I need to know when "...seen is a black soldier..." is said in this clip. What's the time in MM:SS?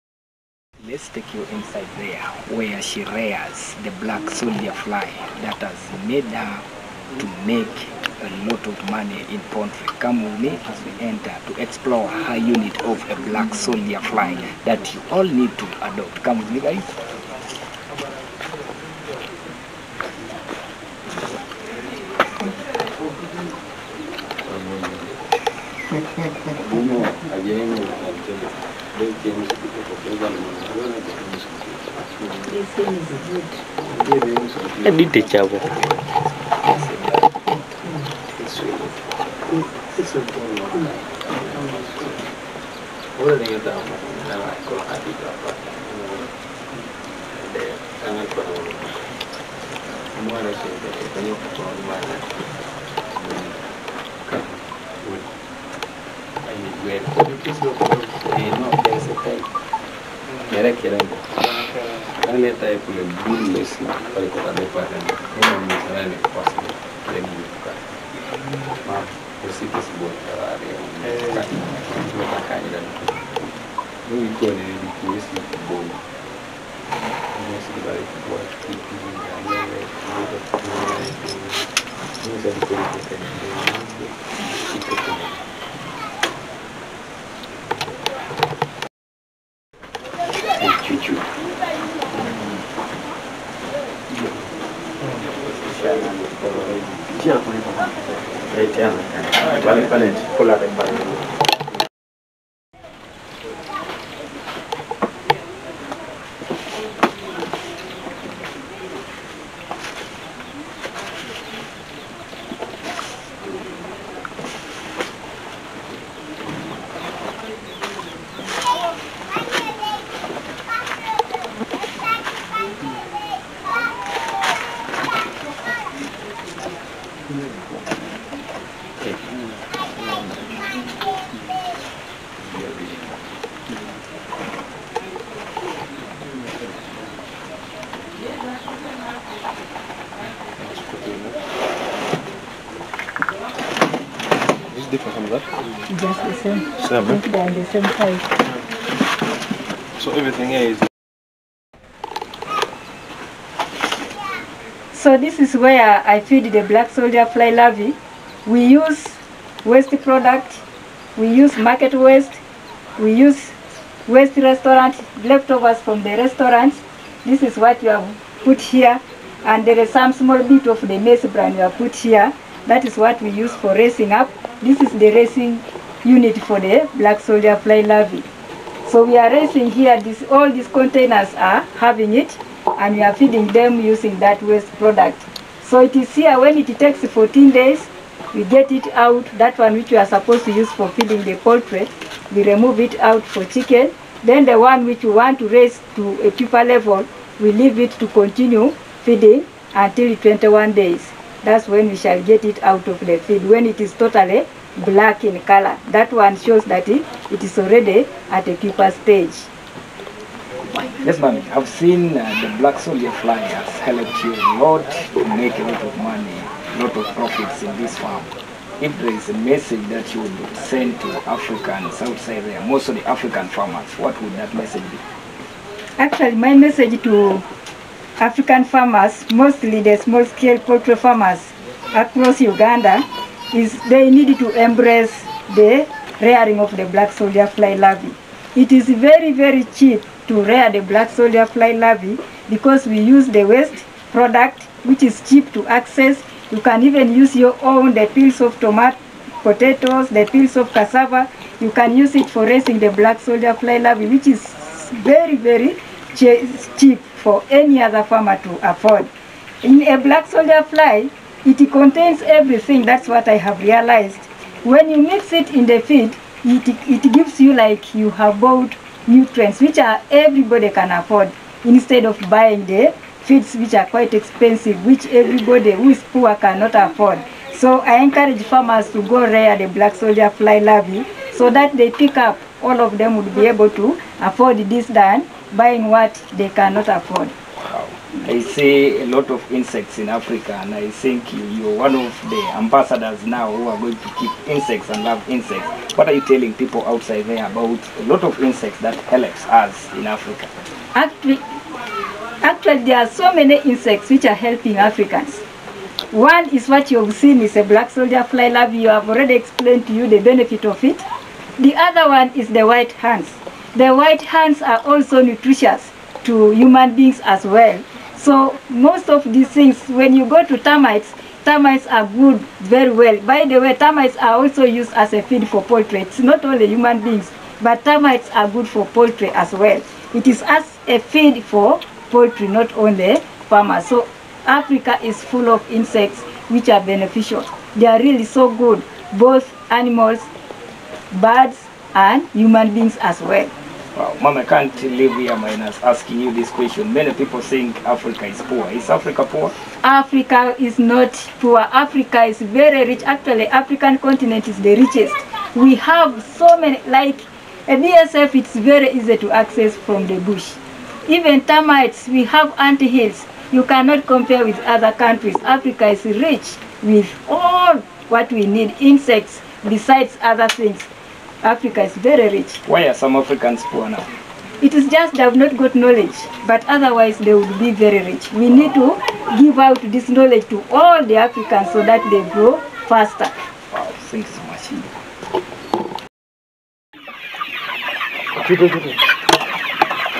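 05:07.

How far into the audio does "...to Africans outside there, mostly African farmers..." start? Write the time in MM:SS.
03:41.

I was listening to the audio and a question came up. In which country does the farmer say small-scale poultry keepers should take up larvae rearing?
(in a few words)
Uganda.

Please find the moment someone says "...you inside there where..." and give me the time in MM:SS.
00:01.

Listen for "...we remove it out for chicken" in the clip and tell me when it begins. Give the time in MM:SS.
03:12.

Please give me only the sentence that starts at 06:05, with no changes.
Africa is rich with all what we need, insects, besides other things.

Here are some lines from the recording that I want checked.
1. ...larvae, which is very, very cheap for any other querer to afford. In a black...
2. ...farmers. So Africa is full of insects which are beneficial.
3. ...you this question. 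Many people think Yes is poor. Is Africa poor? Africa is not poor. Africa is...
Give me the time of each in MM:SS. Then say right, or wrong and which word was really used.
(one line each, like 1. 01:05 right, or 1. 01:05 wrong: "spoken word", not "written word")
1. 04:13 wrong: "farmer", not "querer"
2. 05:33 right
3. 05:46 wrong: "Africa", not "Yes".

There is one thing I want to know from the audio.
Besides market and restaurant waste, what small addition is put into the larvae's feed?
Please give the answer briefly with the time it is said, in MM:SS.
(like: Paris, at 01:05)
maize bran, at 02:50.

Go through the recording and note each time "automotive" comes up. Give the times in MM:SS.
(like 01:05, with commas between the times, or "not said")
not said.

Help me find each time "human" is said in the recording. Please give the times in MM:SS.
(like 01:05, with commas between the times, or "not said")
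05:16, 05:26, 05:42.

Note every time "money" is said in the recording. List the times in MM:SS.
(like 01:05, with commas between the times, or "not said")
00:08, 03:35.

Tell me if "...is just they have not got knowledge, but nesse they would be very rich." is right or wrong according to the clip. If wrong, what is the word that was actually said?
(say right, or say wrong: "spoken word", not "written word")
wrong: "otherwise", not "nesse".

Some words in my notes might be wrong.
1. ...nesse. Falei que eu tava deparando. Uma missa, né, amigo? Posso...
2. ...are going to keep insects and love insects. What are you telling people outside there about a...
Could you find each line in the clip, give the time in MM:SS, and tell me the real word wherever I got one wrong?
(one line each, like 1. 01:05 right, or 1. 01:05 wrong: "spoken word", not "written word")
1. 01:03 right
2. 04:53 right.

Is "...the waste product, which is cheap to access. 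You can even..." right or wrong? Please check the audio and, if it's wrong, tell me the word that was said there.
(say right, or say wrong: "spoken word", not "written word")
right.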